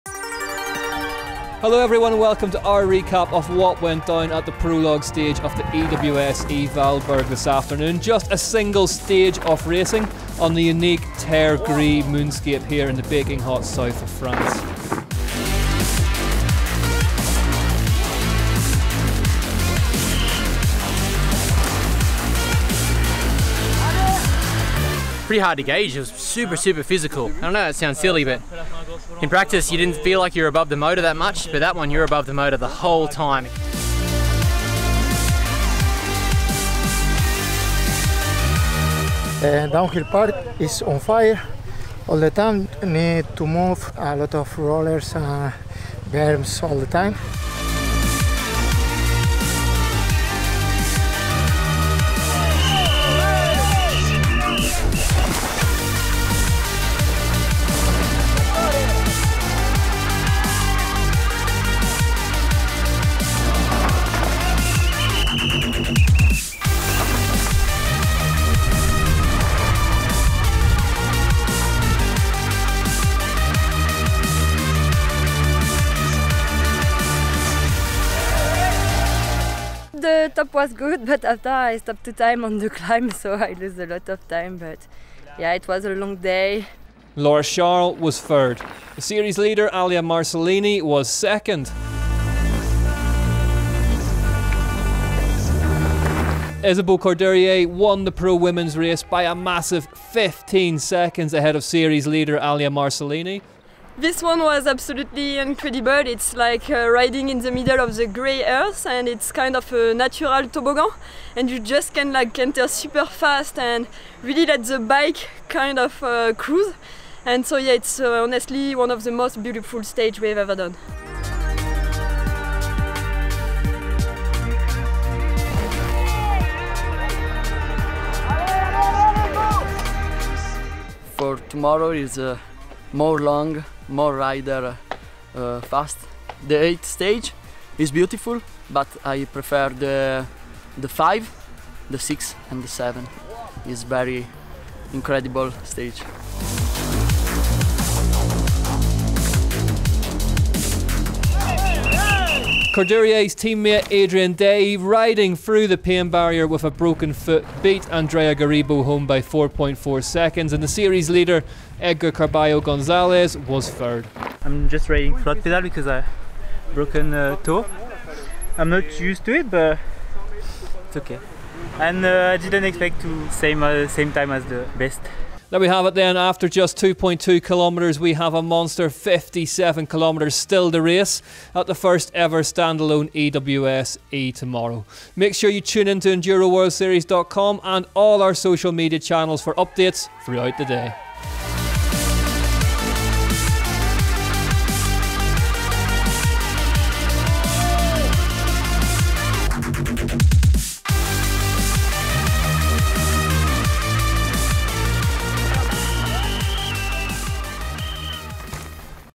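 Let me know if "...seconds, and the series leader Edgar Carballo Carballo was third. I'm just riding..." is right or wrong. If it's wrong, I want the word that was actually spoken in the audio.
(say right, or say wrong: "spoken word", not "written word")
wrong: "Gonzalez", not "Carballo".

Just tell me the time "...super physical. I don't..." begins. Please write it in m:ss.
0:26.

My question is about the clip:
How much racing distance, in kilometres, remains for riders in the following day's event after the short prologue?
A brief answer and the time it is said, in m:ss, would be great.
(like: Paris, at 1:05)
57 kilometres, at 2:58.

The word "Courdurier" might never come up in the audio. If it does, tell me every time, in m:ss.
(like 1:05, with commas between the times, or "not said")
1:36, 2:32.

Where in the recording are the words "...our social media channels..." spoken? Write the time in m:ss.
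3:08.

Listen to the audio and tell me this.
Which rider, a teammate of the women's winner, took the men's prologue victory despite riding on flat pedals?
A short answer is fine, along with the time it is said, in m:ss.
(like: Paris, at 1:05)
Adrien Dailly, at 2:33.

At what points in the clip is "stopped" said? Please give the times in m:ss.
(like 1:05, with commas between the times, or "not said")
1:21.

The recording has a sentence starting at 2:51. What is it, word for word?
And uh, I didn't expect to same uh, same time as the best.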